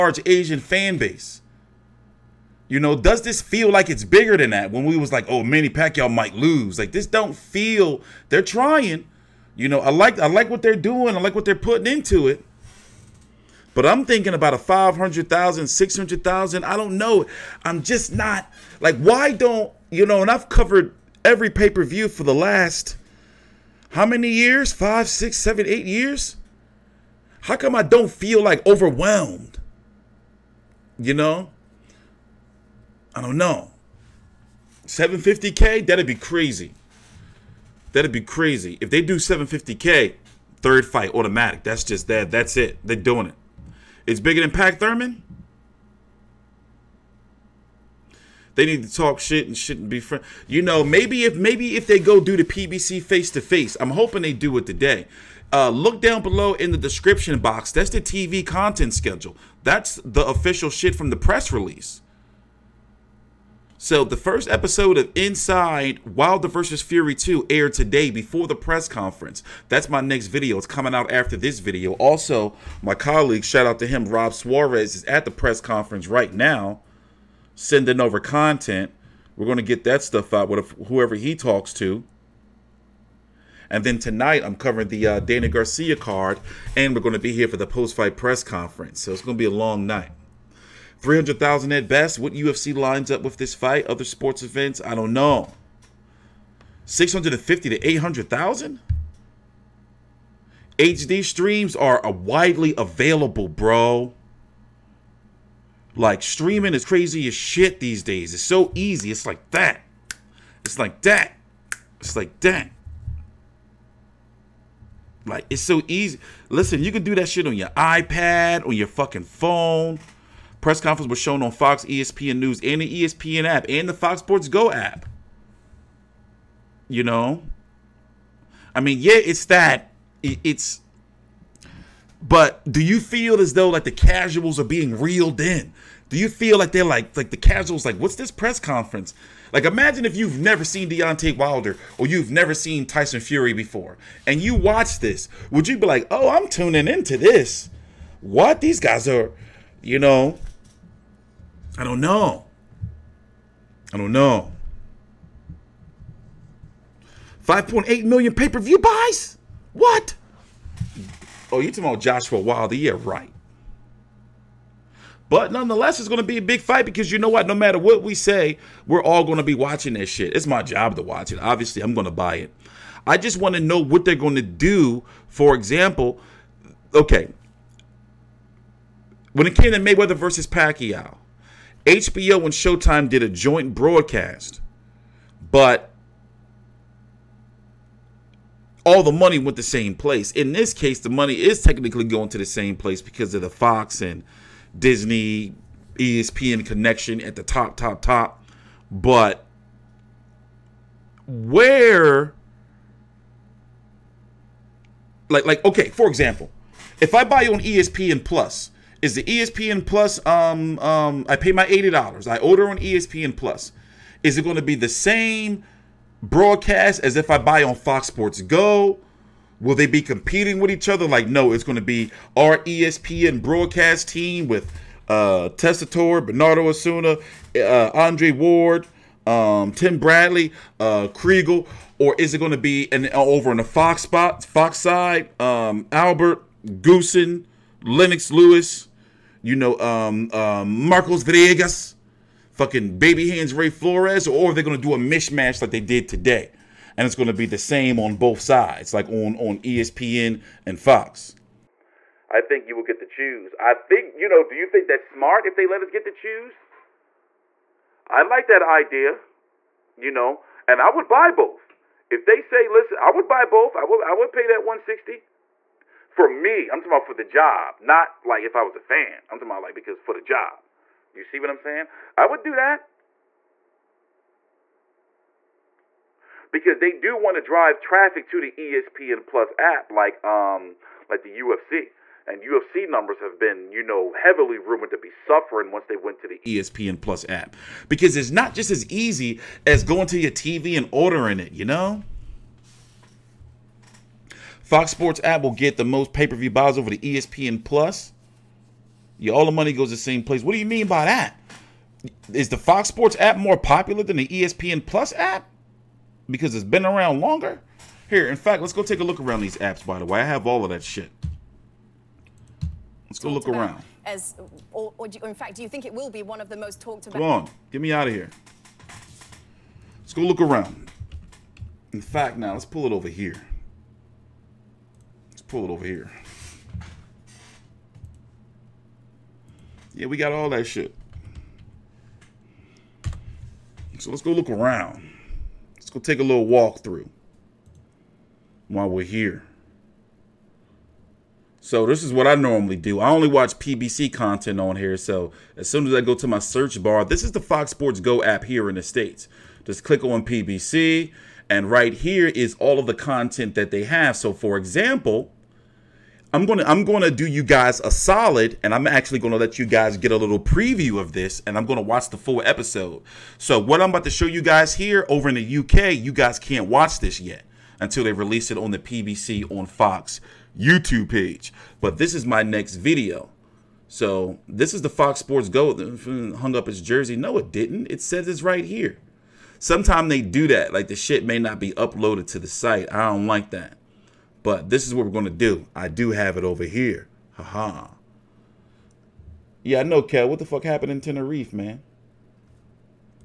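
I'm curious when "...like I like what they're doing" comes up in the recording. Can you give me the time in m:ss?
0:09.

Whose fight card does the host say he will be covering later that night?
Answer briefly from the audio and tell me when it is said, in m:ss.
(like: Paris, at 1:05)
Danny Garcia, at 1:25.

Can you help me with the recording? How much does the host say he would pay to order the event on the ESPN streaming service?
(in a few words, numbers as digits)
$80.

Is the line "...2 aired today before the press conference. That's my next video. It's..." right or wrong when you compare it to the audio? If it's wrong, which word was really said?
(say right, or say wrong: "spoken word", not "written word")
right.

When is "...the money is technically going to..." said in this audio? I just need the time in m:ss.
3:10.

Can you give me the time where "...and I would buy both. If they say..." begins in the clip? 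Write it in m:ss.
4:20.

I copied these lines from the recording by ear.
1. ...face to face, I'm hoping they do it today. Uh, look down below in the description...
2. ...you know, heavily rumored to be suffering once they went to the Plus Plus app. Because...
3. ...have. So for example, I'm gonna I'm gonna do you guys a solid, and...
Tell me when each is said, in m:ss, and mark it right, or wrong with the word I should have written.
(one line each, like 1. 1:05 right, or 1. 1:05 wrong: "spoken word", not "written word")
1. 0:53 right
2. 4:43 wrong: "ESPN", not "Plus"
3. 5:53 right.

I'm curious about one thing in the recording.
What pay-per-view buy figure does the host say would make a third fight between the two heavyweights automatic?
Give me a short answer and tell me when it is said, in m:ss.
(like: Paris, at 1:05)
750K, at 0:38.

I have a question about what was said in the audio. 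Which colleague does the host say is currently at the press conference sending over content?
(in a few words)
Rob Suarez.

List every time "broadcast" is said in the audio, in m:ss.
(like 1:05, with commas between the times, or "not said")
3:03, 3:36, 3:43.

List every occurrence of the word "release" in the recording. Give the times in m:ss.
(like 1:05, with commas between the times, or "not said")
1:01, 6:08.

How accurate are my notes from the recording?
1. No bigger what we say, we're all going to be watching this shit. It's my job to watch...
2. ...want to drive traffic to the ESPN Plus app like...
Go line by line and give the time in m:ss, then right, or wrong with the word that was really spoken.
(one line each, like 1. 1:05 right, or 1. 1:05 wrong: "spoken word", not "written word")
1. 2:47 wrong: "matter", not "bigger"
2. 4:37 right.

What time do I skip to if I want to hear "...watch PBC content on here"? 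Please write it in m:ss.
5:43.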